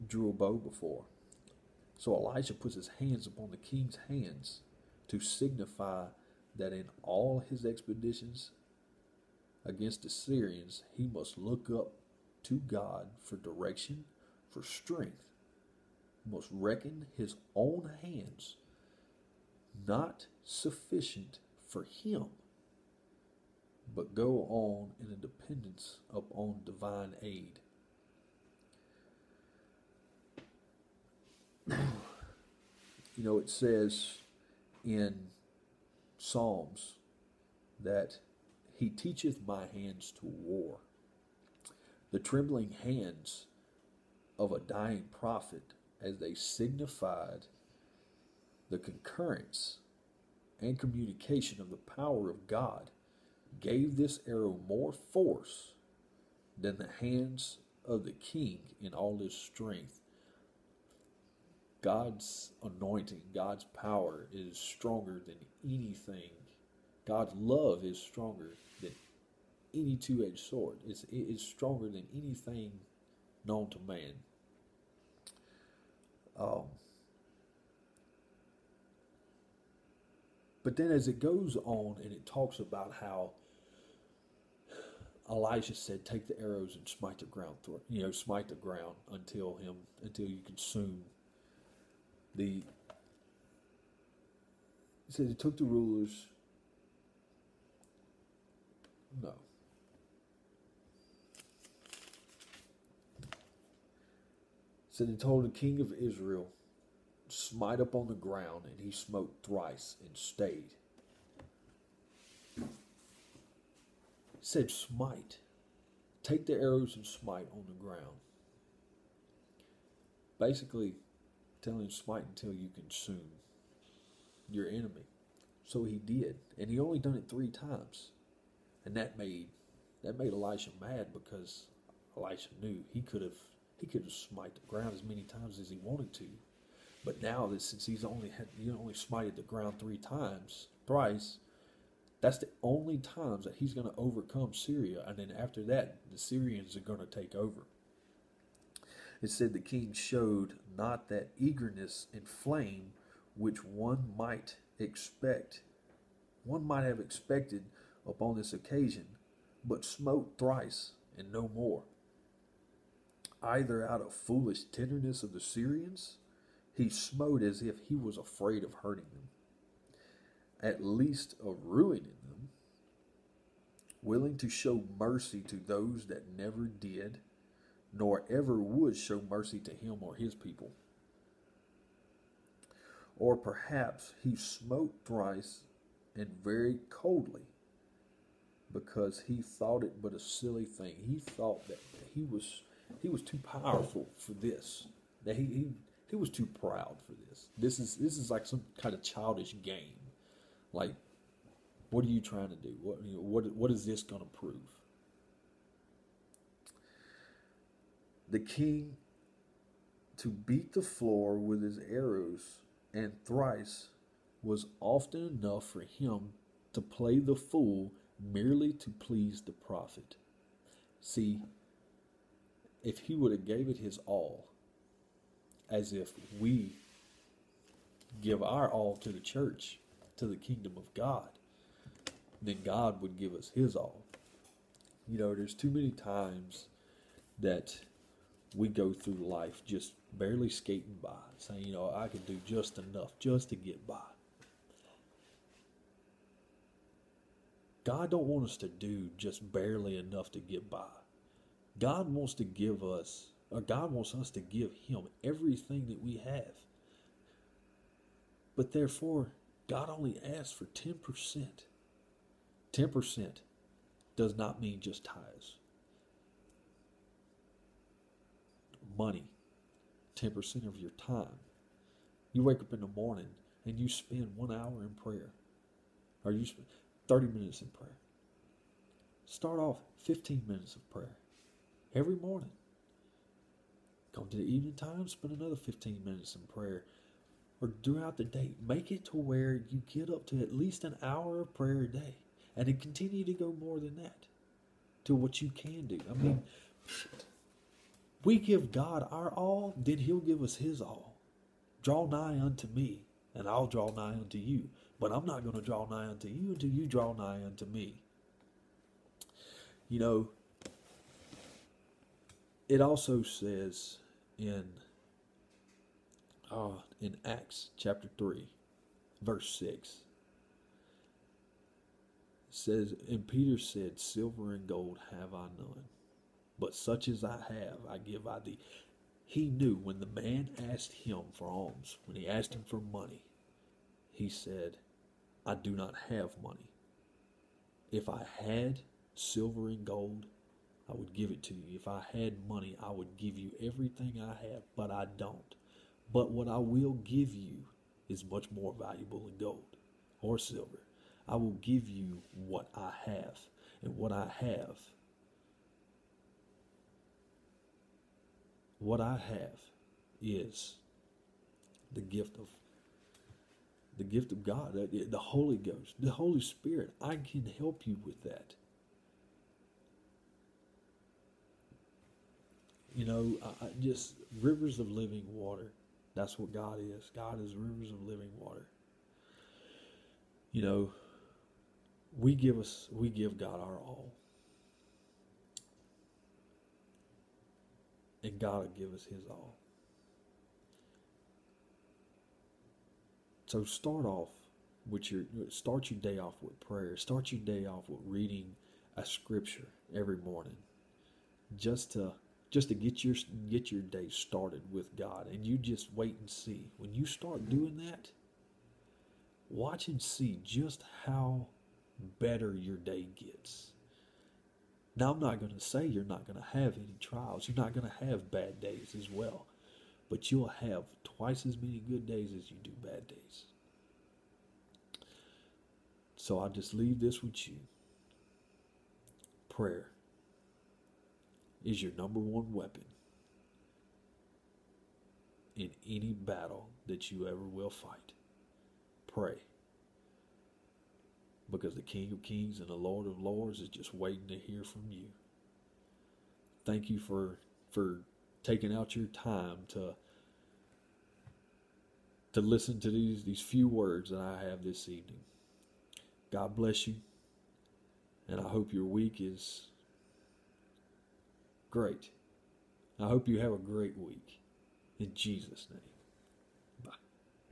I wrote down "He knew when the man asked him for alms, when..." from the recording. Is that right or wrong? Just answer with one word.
right.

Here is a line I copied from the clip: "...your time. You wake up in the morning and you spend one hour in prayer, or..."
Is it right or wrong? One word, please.
right.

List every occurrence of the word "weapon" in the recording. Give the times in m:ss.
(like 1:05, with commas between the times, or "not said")
7:12.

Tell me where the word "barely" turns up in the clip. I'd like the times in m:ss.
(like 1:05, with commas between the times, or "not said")
4:00, 4:09.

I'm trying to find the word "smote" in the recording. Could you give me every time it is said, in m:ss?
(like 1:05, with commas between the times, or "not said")
1:48, 2:39, 2:46, 3:04.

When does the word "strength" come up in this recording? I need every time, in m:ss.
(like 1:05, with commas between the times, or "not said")
0:14, 0:59.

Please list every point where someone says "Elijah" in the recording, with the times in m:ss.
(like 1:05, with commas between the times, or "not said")
1:25.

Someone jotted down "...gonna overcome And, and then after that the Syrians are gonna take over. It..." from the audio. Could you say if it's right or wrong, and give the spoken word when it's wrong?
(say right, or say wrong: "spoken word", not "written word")
wrong: "Syria", not "And".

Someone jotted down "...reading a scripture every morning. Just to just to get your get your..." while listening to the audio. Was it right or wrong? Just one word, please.
right.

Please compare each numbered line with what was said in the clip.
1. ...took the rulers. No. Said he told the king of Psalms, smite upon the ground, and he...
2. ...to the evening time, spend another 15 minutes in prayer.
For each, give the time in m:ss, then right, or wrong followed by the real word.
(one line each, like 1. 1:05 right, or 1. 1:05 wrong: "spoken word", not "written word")
1. 1:35 wrong: "Israel", not "Psalms"
2. 4:44 right.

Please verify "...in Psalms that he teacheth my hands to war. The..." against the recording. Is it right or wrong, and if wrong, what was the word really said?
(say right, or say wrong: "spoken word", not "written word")
right.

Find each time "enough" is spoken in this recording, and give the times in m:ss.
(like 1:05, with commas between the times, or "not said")
3:35, 4:02, 4:09.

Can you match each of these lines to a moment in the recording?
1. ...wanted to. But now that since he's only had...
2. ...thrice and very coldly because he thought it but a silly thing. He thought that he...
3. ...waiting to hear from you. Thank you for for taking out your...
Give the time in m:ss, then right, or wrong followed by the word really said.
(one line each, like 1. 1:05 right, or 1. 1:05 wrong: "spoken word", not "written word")
1. 2:15 right
2. 3:05 right
3. 7:23 right.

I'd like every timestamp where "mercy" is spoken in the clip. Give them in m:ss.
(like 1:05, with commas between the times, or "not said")
2:54, 2:59.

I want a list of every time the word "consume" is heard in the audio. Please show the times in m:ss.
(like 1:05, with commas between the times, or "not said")
1:30, 2:02.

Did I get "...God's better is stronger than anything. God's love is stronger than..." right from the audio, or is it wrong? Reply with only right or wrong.
wrong.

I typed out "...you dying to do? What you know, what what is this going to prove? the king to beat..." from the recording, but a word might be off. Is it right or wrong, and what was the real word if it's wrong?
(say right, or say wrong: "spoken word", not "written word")
wrong: "trying", not "dying".